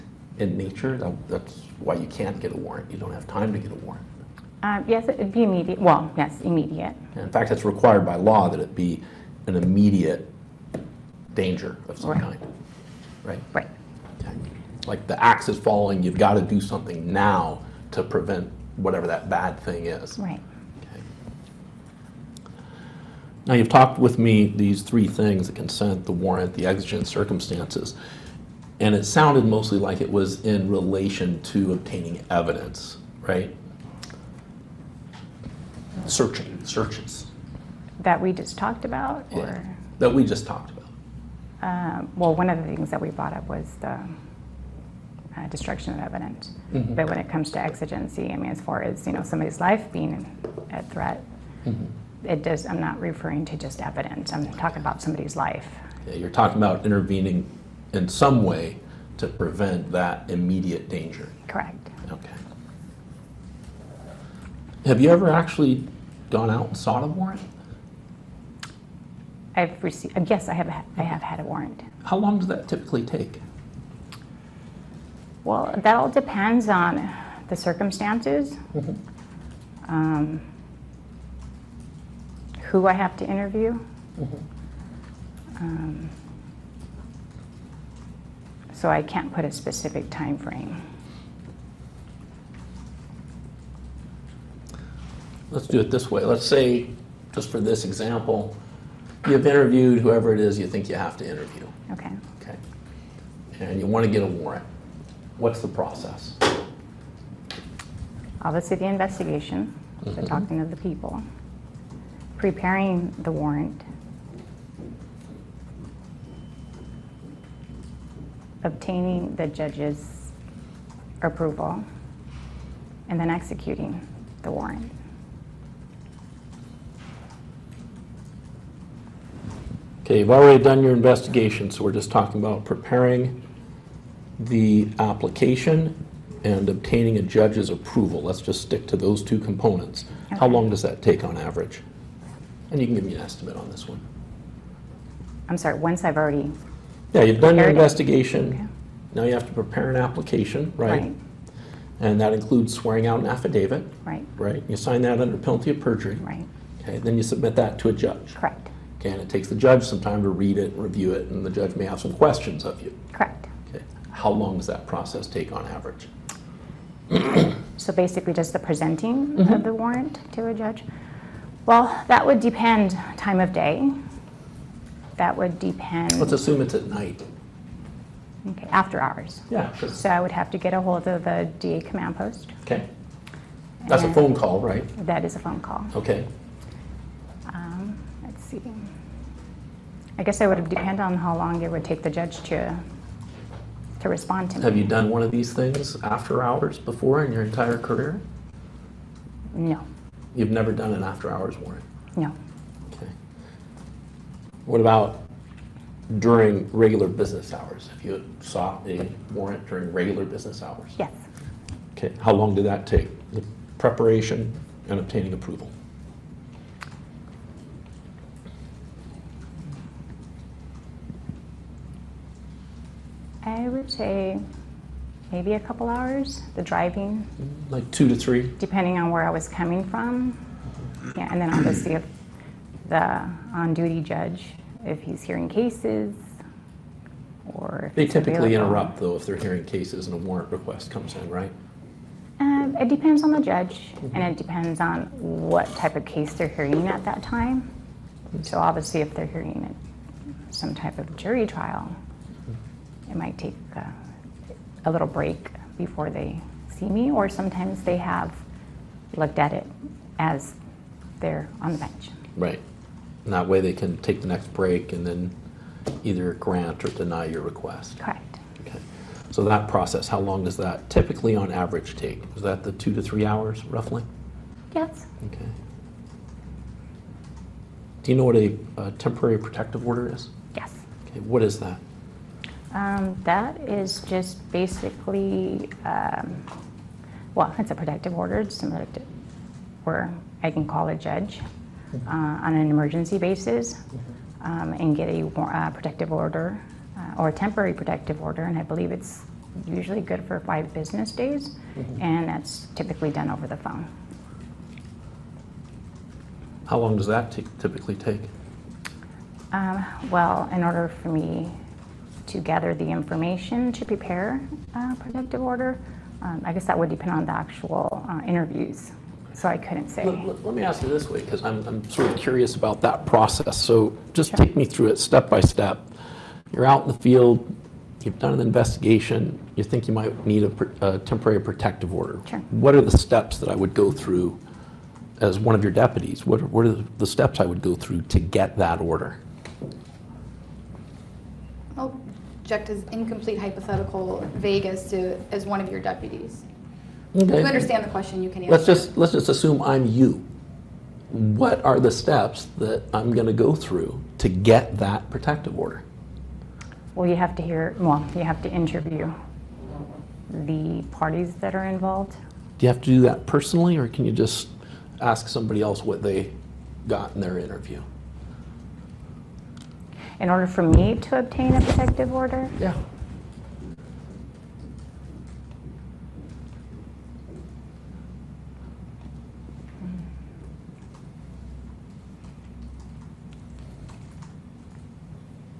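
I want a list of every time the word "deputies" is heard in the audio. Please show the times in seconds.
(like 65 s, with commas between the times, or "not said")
335 s, 345 s.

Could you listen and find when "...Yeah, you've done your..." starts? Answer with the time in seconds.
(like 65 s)
147 s.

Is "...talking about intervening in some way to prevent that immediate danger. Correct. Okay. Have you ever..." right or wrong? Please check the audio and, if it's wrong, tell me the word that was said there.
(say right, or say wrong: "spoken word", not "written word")
right.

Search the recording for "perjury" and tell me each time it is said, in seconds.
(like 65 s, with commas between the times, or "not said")
155 s.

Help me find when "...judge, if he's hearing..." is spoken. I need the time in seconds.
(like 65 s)
234 s.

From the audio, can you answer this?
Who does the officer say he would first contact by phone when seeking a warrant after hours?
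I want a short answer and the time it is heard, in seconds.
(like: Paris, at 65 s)
DA command post, at 181 s.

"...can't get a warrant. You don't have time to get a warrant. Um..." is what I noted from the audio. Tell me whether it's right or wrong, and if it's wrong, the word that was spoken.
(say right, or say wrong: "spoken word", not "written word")
right.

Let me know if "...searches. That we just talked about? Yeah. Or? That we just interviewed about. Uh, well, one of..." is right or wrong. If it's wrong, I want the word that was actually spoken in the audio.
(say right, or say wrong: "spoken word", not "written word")
wrong: "talked", not "interviewed".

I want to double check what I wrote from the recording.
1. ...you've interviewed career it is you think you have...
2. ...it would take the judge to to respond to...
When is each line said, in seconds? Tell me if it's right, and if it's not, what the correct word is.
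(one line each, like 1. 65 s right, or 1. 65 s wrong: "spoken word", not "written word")
1. 99 s wrong: "whoever", not "career"
2. 191 s right.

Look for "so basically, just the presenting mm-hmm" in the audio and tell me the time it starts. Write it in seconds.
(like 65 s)
167 s.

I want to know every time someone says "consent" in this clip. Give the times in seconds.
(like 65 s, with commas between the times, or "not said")
25 s.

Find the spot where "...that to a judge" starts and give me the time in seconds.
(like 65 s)
157 s.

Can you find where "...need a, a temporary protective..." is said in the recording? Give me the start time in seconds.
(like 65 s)
330 s.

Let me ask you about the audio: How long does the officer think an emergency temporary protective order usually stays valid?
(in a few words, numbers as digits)
5 business days.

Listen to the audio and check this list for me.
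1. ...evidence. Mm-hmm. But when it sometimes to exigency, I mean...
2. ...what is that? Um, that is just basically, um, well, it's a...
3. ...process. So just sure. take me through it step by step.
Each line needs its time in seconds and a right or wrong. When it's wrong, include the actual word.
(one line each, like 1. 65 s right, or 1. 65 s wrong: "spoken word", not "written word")
1. 46 s wrong: "comes", not "sometimes"
2. 281 s right
3. 323 s right.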